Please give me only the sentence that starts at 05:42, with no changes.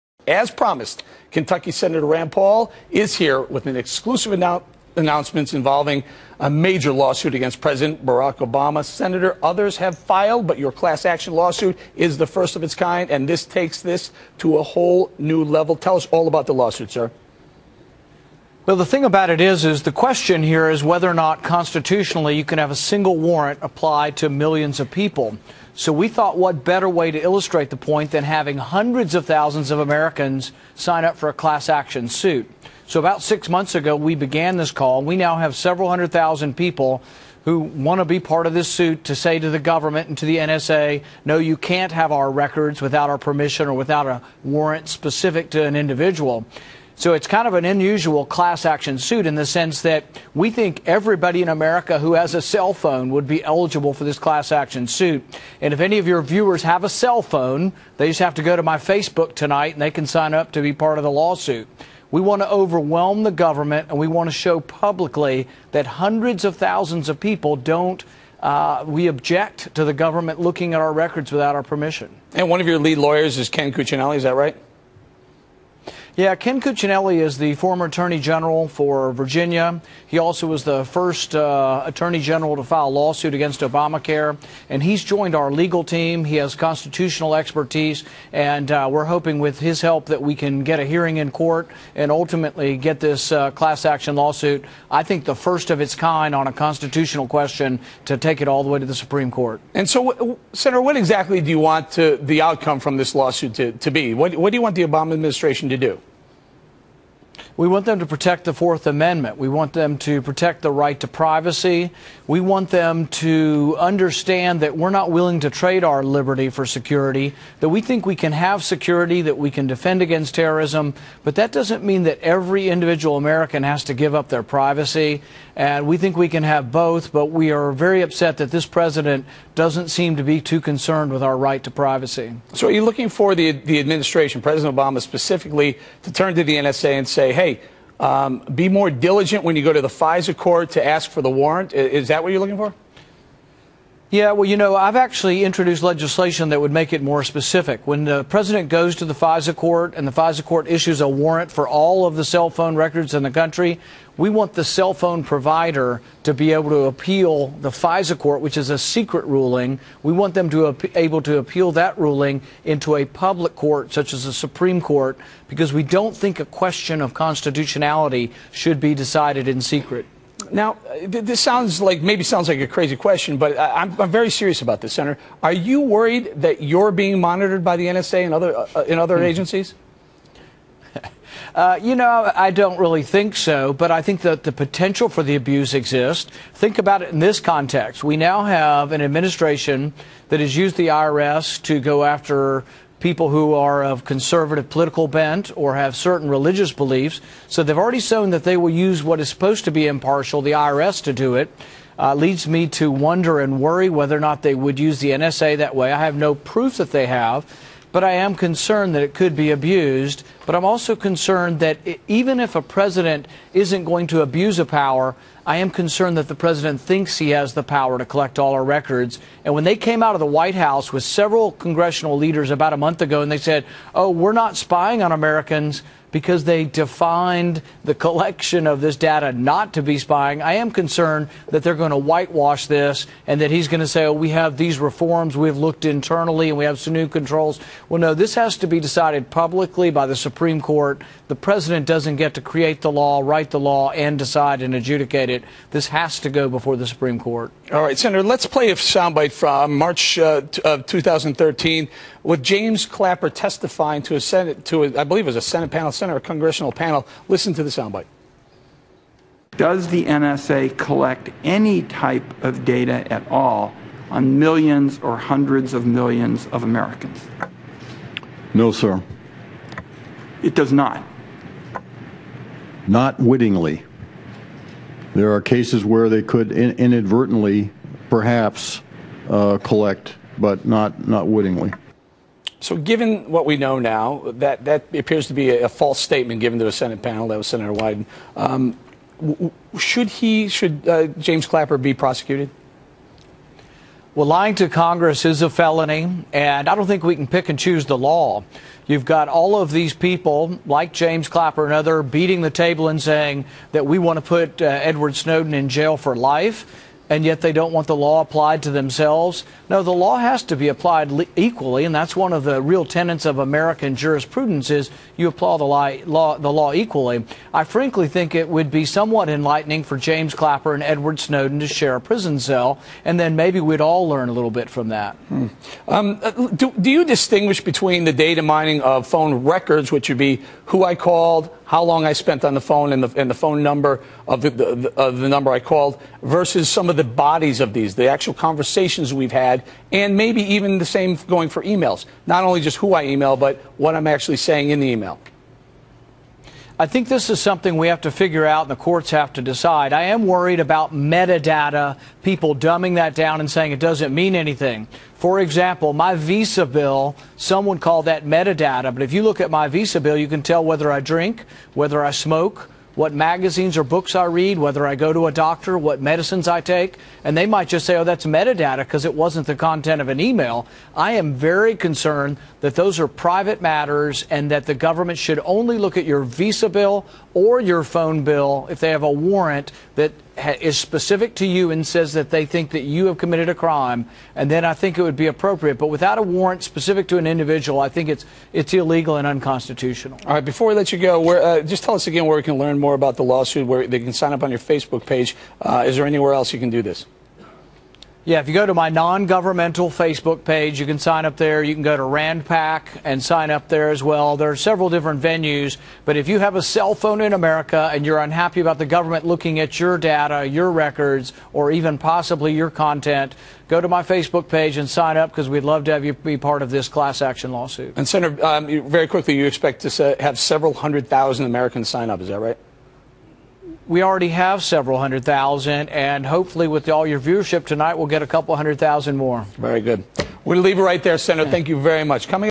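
Not only just who I email, but what I'm actually saying in the email.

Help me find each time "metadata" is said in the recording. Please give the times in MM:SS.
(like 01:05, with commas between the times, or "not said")
05:50, 05:58, 06:08.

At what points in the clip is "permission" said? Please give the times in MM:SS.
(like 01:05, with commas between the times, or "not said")
00:43, 01:11.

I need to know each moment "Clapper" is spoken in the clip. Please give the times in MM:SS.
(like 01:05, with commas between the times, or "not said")
04:12, 04:51, 05:01, 05:20.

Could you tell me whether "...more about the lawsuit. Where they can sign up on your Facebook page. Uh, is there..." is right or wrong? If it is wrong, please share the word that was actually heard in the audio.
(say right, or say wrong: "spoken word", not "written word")
right.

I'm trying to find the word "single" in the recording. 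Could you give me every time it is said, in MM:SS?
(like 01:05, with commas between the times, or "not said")
00:22.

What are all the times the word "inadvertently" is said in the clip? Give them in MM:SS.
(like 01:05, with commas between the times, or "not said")
04:36.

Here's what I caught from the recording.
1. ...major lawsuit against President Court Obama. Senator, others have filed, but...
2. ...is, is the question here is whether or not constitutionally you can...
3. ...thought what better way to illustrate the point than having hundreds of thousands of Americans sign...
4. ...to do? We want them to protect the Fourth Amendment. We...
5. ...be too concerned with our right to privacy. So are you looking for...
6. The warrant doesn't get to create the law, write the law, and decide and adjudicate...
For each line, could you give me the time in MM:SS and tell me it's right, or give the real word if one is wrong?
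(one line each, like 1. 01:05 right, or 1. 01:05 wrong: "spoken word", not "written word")
1. 00:06 wrong: "Barack", not "Court"
2. 00:19 right
3. 00:26 right
4. 01:45 right
5. 02:10 right
6. 04:01 wrong: "president", not "warrant".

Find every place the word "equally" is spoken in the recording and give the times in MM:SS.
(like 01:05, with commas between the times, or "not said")
05:11, 05:16.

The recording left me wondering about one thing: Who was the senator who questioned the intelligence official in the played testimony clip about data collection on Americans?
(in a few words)
Senator Wyden.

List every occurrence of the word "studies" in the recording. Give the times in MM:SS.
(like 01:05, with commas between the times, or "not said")
not said.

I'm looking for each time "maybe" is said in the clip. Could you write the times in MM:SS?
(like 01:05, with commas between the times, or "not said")
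02:52, 05:23, 05:40.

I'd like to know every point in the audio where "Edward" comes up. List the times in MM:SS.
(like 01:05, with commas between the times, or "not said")
05:04, 05:20.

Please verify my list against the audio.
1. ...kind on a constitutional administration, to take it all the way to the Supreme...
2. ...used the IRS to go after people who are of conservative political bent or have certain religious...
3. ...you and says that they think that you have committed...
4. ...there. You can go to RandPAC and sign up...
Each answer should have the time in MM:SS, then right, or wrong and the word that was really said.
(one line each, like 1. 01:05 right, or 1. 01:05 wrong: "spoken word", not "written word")
1. 01:35 wrong: "question", not "administration"
2. 03:10 right
3. 06:21 right
4. 06:41 right.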